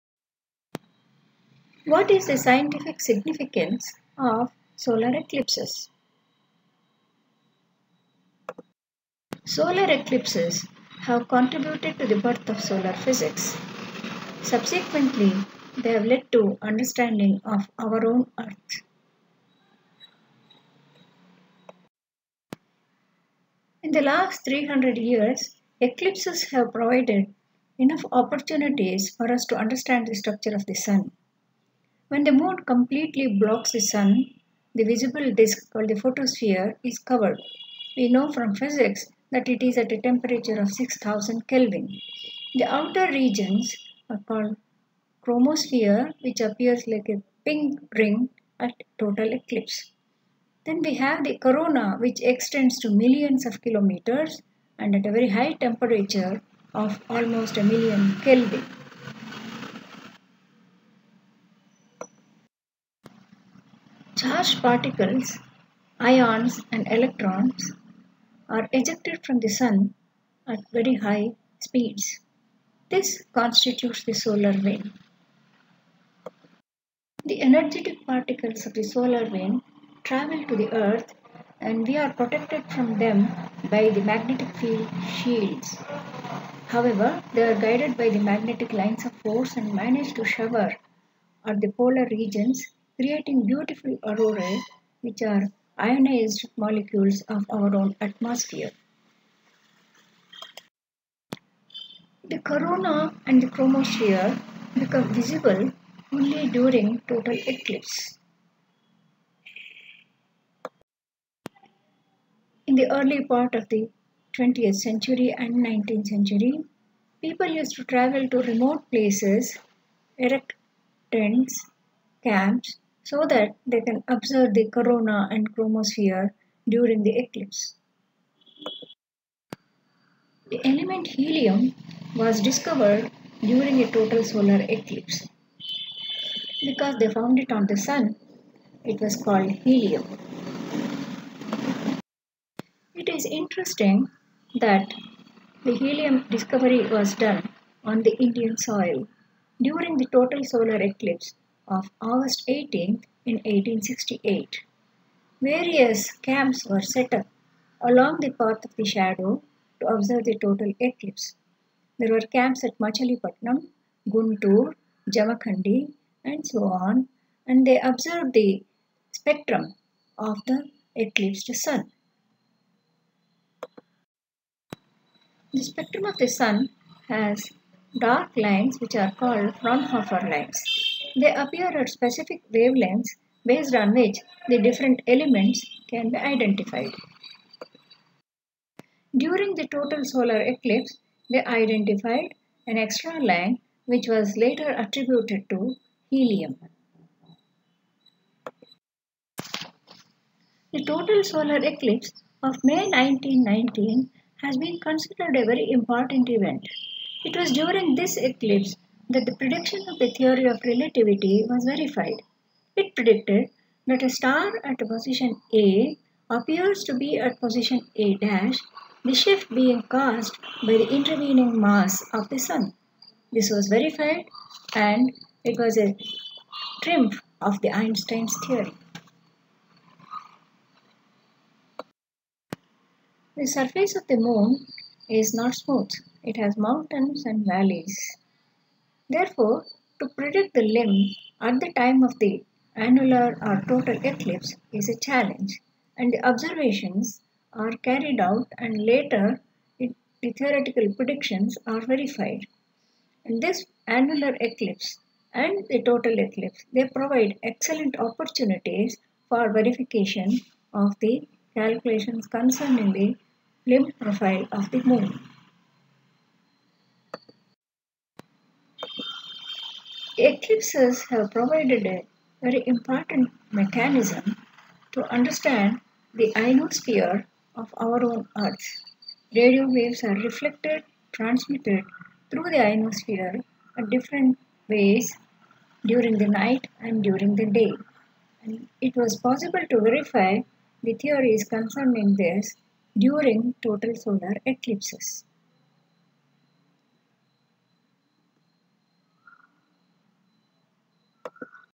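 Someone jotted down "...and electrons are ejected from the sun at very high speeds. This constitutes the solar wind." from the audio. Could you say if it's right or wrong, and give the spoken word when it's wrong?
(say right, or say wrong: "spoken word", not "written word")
right.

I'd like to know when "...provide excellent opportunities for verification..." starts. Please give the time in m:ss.
4:16.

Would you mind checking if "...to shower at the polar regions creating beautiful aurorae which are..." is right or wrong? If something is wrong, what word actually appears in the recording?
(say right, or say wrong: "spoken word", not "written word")
right.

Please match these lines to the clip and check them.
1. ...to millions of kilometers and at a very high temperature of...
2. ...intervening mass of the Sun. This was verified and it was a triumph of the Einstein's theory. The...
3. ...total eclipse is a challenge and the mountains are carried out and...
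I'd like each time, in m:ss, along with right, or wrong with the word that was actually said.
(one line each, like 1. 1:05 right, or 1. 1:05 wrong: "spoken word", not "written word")
1. 0:52 right
2. 3:40 right
3. 4:03 wrong: "observations", not "mountains".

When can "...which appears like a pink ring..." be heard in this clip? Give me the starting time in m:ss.
0:46.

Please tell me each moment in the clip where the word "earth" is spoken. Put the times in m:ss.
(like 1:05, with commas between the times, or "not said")
0:18, 1:20, 4:38.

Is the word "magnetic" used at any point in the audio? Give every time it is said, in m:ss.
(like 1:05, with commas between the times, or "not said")
1:24, 1:28.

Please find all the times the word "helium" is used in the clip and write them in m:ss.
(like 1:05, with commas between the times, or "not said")
2:11, 2:19, 2:25, 3:16.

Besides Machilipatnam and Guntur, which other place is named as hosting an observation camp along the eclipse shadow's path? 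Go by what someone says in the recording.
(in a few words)
Jamakhandi.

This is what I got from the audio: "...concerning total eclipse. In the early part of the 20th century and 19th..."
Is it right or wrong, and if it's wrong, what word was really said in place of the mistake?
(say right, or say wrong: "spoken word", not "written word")
wrong: "during", not "concerning".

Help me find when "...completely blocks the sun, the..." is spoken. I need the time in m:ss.
0:32.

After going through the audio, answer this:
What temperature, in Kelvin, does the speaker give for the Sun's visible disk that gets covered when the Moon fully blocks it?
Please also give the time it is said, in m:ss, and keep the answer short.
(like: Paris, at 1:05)
6000 Kelvin, at 0:40.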